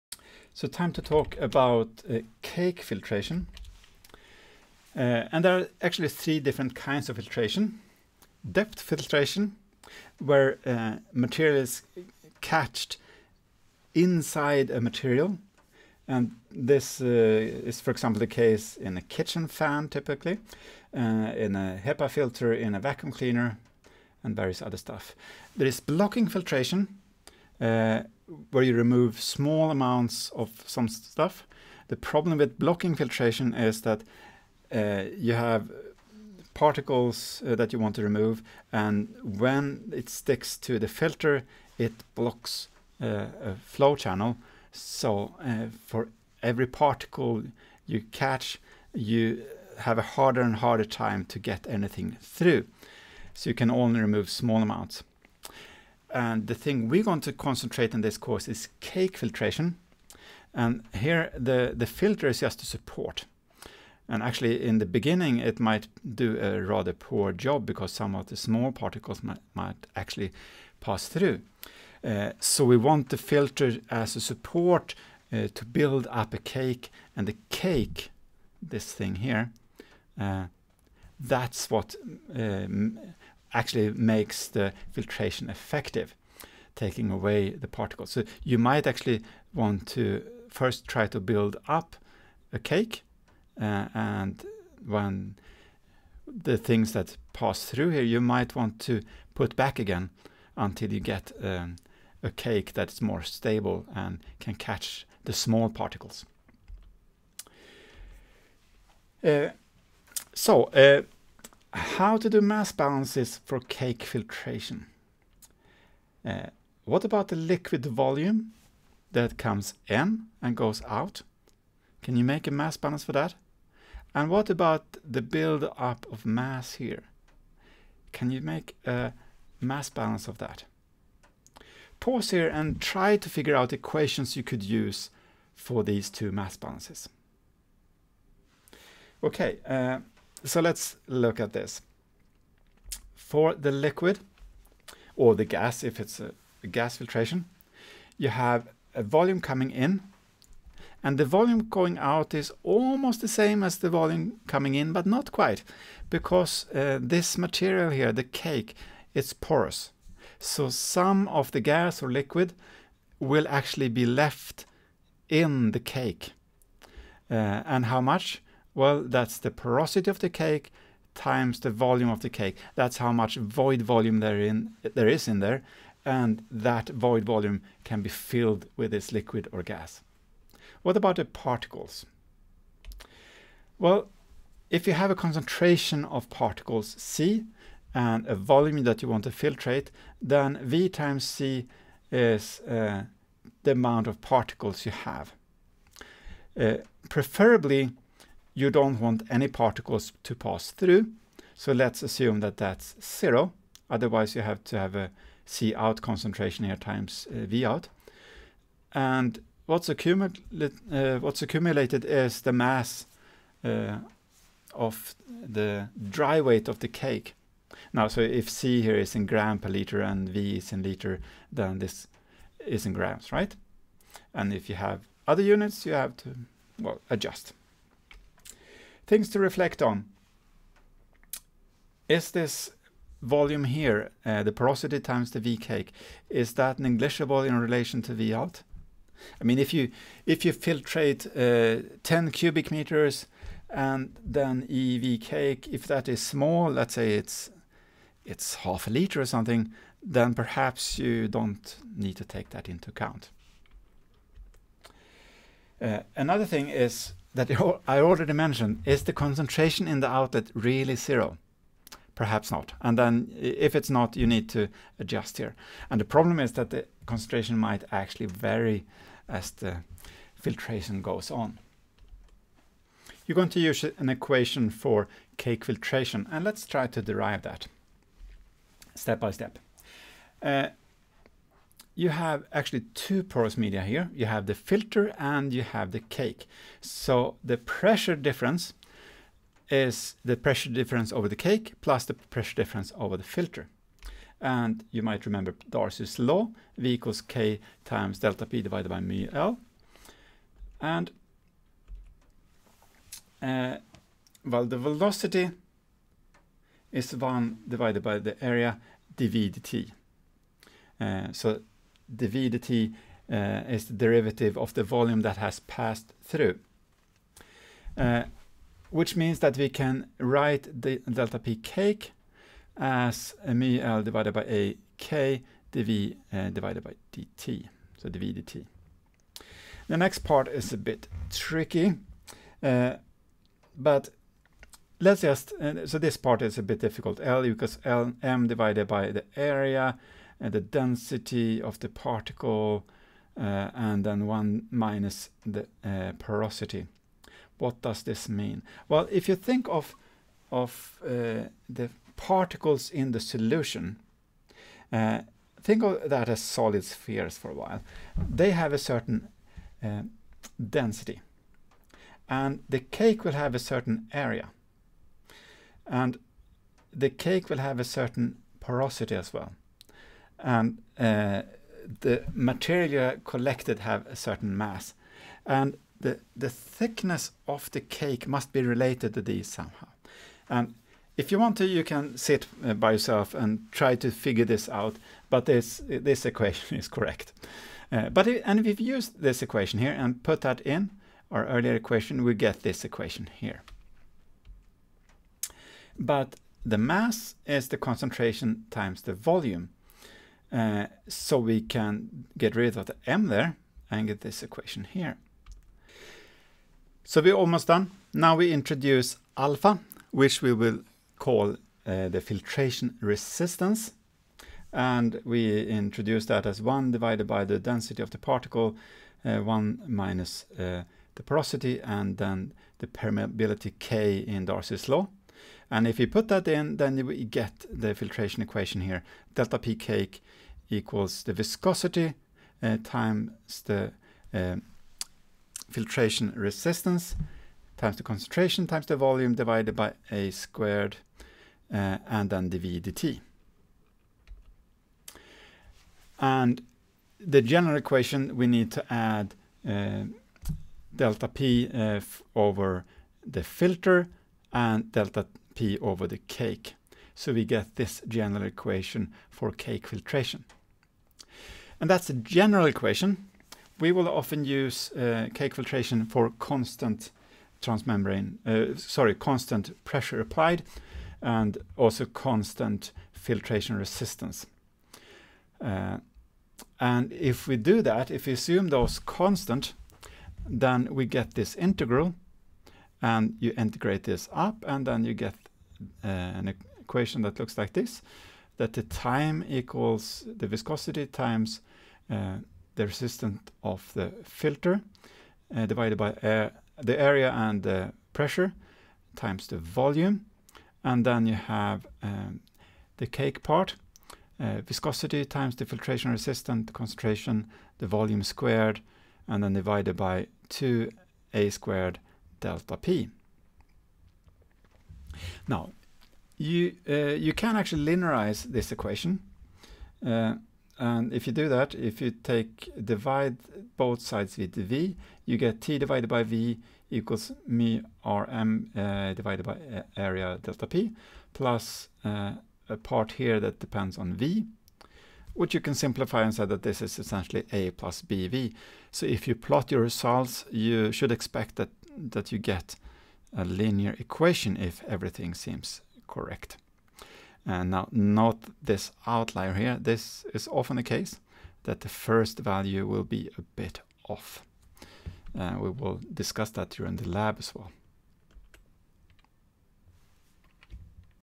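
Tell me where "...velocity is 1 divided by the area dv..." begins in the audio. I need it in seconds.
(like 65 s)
304 s.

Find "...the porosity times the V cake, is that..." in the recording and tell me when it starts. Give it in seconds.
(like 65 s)
234 s.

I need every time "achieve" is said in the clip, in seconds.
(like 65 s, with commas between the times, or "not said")
not said.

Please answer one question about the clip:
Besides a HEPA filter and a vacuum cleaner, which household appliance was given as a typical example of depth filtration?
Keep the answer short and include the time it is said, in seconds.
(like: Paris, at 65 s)
Kitchen fan, at 19 s.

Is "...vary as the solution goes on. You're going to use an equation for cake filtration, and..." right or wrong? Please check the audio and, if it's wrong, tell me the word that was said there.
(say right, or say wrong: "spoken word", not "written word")
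wrong: "filtration", not "solution".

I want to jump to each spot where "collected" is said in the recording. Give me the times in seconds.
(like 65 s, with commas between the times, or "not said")
373 s.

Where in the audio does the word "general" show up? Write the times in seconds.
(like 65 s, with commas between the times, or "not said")
447 s, 458 s, 462 s.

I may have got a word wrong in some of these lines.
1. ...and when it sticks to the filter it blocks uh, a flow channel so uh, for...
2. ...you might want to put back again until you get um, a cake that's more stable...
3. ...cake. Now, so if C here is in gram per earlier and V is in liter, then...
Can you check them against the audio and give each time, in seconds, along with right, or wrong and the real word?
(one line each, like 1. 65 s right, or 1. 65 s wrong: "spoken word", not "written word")
1. 38 s right
2. 98 s right
3. 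216 s wrong: "liter", not "earlier".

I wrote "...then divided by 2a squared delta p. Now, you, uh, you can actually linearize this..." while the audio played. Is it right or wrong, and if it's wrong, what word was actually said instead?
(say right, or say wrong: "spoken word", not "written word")
right.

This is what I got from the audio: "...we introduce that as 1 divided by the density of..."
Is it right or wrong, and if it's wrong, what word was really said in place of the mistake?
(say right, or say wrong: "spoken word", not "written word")
right.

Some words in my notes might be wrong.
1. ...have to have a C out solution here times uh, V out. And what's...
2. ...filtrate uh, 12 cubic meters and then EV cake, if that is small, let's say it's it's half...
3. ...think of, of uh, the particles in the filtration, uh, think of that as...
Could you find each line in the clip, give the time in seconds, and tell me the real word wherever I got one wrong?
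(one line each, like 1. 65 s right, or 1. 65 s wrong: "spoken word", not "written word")
1. 204 s wrong: "concentration", not "solution"
2. 240 s wrong: "10", not "12"
3. 349 s wrong: "solution", not "filtration".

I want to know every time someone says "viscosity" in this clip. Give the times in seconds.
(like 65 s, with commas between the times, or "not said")
431 s, 490 s, 504 s.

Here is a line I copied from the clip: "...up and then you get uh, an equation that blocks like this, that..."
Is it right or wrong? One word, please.
wrong.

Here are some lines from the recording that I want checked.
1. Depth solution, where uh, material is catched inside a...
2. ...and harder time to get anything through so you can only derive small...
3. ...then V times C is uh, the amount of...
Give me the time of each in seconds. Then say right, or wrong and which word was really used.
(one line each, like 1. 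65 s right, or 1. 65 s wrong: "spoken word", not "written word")
1. 8 s wrong: "filtration", not "solution"
2. 50 s wrong: "remove", not "derive"
3. 190 s right.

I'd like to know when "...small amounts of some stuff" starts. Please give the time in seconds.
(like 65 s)
29 s.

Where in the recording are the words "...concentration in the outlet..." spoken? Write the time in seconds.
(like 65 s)
259 s.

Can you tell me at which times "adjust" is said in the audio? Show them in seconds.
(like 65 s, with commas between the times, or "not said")
227 s, 264 s.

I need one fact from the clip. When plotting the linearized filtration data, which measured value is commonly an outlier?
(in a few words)
The first value.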